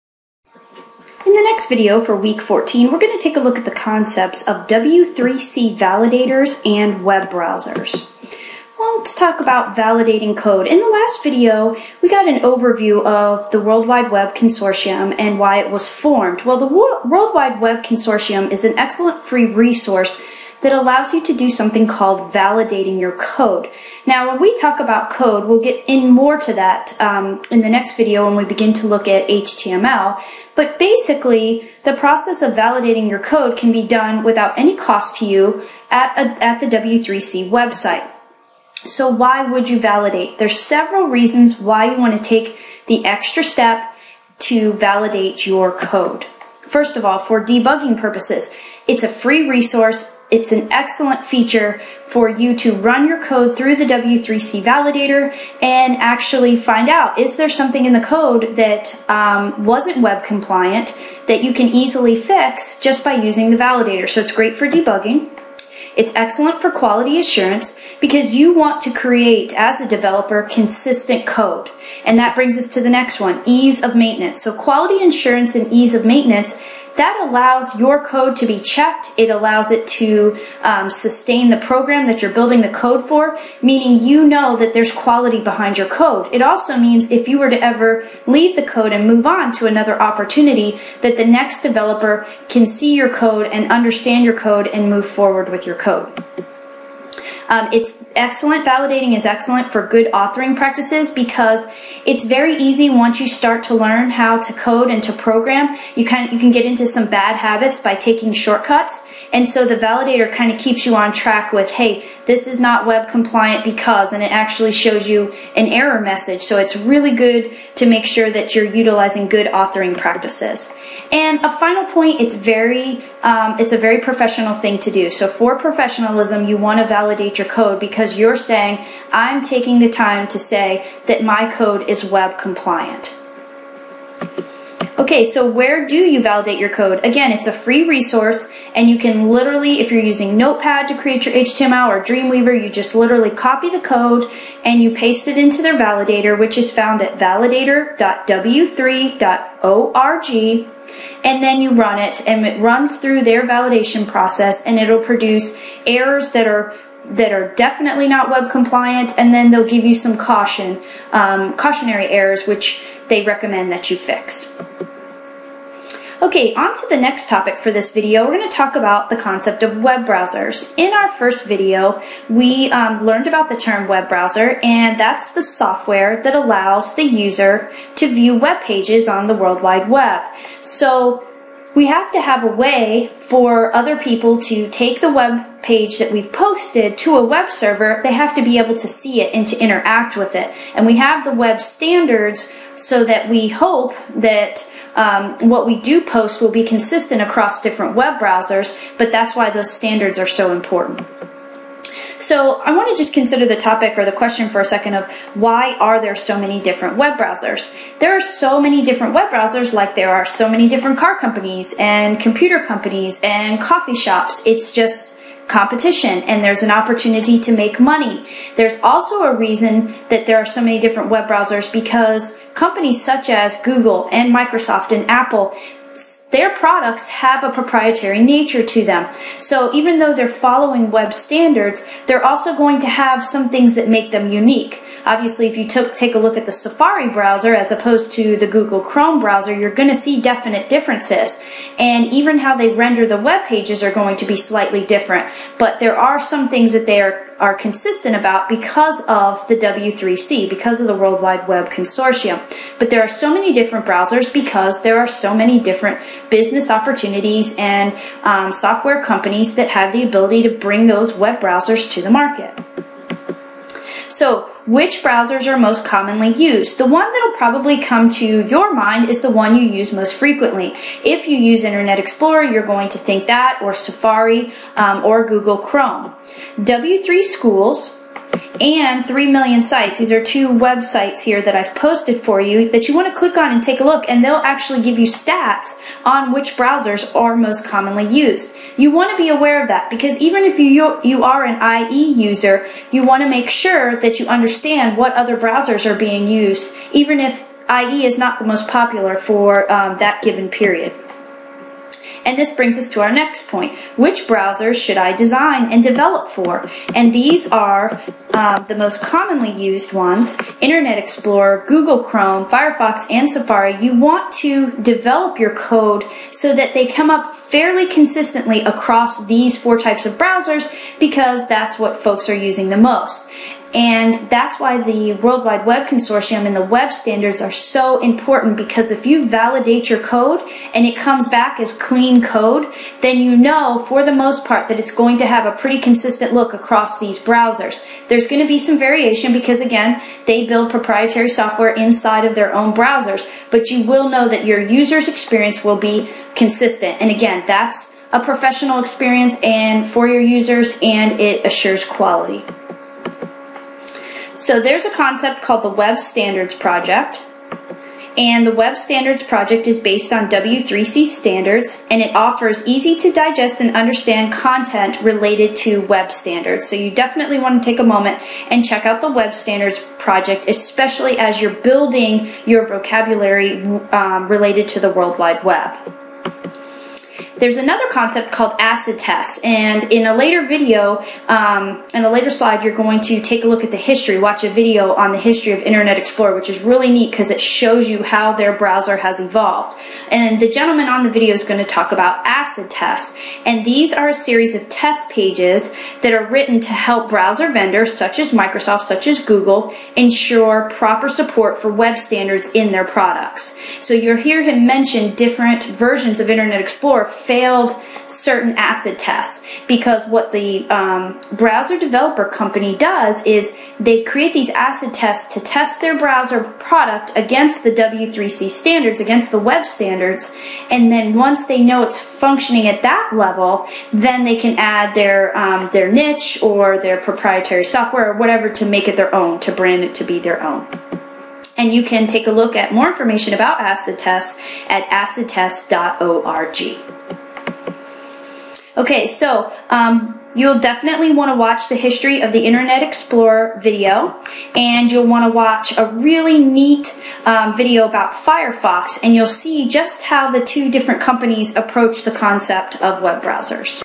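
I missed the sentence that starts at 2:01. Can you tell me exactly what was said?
And a final point, it's very um, it's a very professional thing to do.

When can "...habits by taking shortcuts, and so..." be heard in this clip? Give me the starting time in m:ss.
1:47.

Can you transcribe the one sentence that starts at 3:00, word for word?
So we have to have a way for other people to take the web page that we've posted to a web server.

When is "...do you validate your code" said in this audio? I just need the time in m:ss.
2:15.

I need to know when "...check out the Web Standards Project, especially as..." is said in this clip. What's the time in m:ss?
6:08.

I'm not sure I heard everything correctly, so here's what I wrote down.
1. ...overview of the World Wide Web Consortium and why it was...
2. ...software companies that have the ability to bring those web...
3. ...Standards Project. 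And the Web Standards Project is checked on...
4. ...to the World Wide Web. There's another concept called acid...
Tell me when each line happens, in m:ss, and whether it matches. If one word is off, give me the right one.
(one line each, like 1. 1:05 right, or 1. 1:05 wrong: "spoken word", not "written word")
1. 0:12 right
2. 4:18 right
3. 5:55 wrong: "based", not "checked"
4. 6:14 right.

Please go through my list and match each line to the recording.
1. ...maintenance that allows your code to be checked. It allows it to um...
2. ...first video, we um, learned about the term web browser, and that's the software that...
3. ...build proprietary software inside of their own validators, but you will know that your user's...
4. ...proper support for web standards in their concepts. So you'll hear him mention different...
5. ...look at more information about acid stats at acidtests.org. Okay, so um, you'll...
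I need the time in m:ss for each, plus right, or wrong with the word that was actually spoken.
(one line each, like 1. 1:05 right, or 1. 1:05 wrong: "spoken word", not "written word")
1. 1:16 right
2. 2:51 right
3. 5:40 wrong: "browsers", not "validators"
4. 6:40 wrong: "products", not "concepts"
5. 7:12 wrong: "tests", not "stats".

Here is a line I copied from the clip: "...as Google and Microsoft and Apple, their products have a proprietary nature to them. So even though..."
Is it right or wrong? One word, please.
right.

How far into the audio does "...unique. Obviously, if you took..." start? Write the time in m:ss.
3:54.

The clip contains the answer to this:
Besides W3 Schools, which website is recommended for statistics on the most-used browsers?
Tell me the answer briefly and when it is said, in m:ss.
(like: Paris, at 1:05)
3 million sites, at 4:39.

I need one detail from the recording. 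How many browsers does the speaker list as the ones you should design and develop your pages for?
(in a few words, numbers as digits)
4.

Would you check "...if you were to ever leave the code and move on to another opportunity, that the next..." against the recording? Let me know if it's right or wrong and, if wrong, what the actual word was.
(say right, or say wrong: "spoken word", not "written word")
right.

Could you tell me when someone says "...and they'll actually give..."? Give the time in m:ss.
4:44.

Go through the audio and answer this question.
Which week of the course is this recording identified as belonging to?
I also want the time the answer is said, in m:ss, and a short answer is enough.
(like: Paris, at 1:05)
14, at 0:02.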